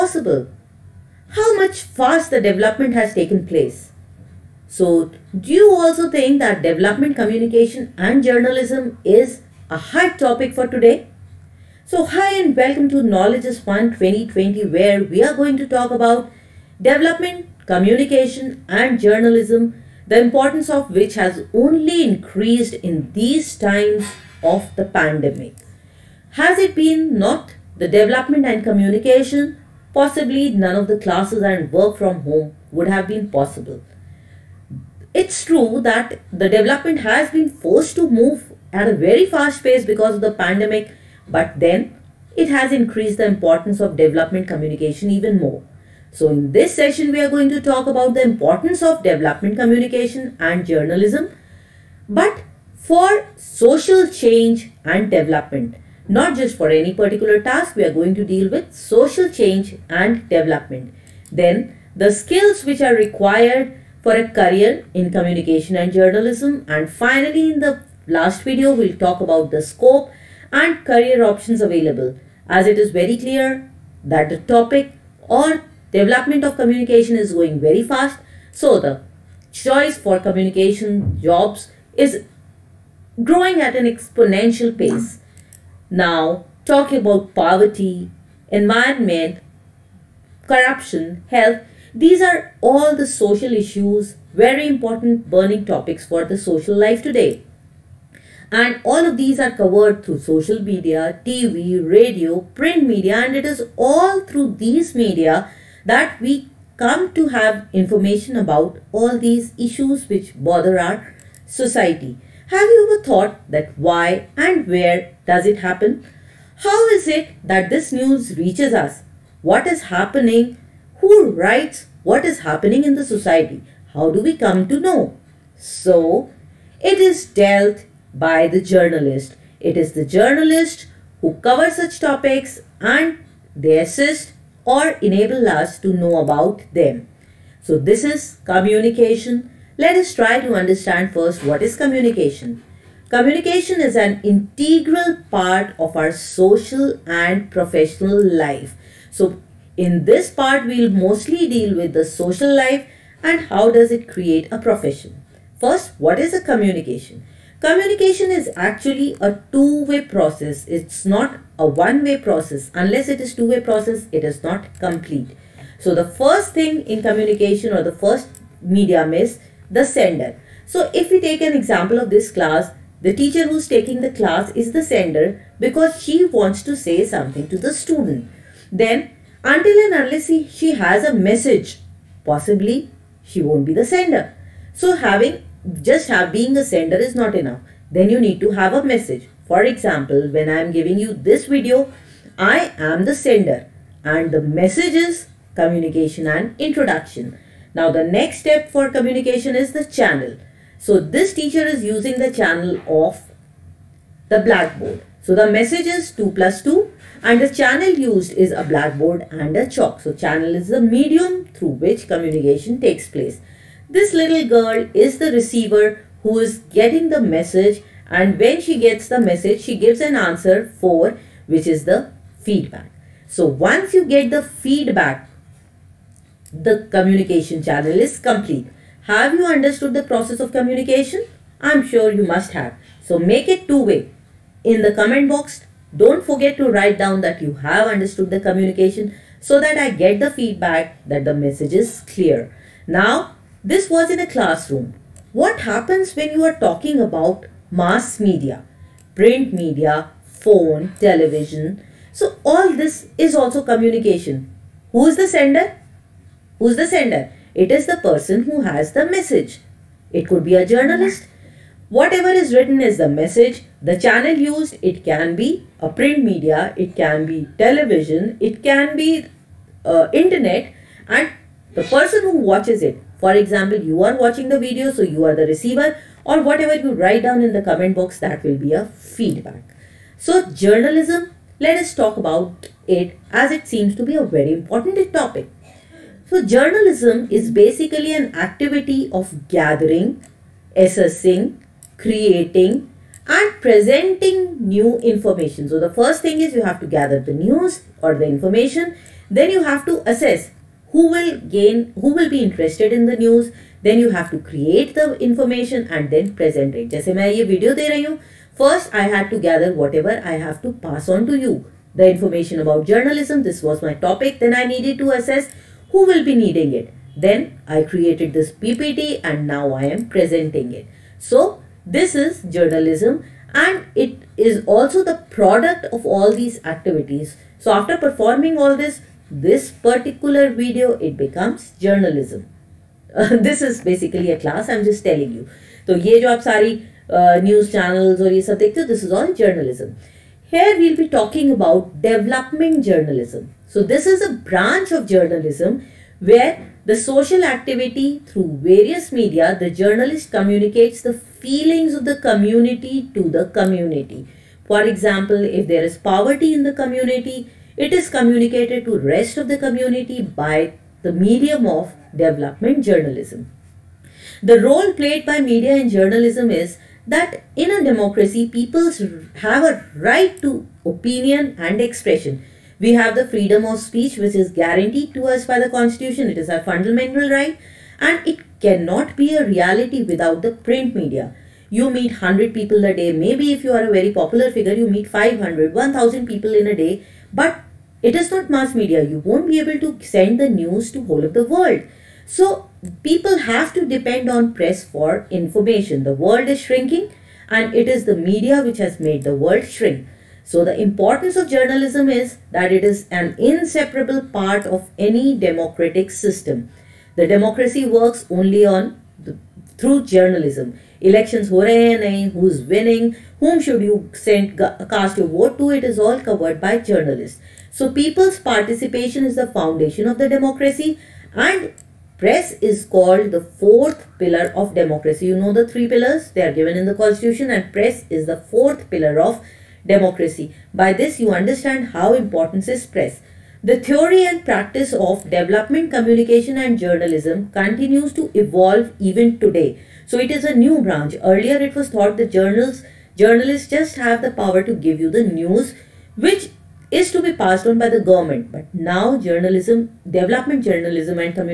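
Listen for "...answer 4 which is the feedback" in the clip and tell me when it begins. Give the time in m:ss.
3:40.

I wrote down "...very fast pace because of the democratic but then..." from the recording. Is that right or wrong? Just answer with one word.
wrong.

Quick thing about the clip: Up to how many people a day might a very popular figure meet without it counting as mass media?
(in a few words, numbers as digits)
1000.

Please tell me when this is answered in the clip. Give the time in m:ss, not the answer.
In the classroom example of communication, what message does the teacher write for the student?
3:26.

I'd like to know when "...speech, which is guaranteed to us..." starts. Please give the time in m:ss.
6:13.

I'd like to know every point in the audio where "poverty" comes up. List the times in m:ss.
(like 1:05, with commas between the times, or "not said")
1:27, 5:55.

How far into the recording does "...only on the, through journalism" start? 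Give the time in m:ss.
6:48.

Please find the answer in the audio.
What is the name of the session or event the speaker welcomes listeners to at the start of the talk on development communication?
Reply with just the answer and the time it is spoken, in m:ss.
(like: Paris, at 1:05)
Knowledge is Fun 2020, at 0:13.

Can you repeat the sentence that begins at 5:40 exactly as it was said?
here we'll be talking about development journalism.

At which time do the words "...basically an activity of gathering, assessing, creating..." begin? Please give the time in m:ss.
4:47.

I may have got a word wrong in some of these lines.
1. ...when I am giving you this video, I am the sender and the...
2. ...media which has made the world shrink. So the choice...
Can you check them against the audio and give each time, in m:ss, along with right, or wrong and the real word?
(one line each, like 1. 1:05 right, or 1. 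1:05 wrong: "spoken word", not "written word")
1. 3:10 right
2. 6:38 wrong: "importance", not "choice".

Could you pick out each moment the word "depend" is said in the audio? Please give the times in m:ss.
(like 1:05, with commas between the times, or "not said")
6:33.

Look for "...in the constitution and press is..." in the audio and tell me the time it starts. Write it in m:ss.
7:06.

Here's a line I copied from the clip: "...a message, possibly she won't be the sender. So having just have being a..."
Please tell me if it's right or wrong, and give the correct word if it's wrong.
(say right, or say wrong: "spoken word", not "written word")
right.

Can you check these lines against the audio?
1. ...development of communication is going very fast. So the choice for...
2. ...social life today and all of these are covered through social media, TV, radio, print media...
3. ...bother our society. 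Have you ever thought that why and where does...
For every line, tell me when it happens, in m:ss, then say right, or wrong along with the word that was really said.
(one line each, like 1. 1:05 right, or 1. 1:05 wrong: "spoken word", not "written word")
1. 1:15 right
2. 1:36 right
3. 1:50 right.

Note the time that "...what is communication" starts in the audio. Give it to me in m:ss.
2:21.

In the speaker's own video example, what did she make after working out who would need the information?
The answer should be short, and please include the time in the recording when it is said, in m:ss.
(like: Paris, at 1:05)
PPT, at 5:18.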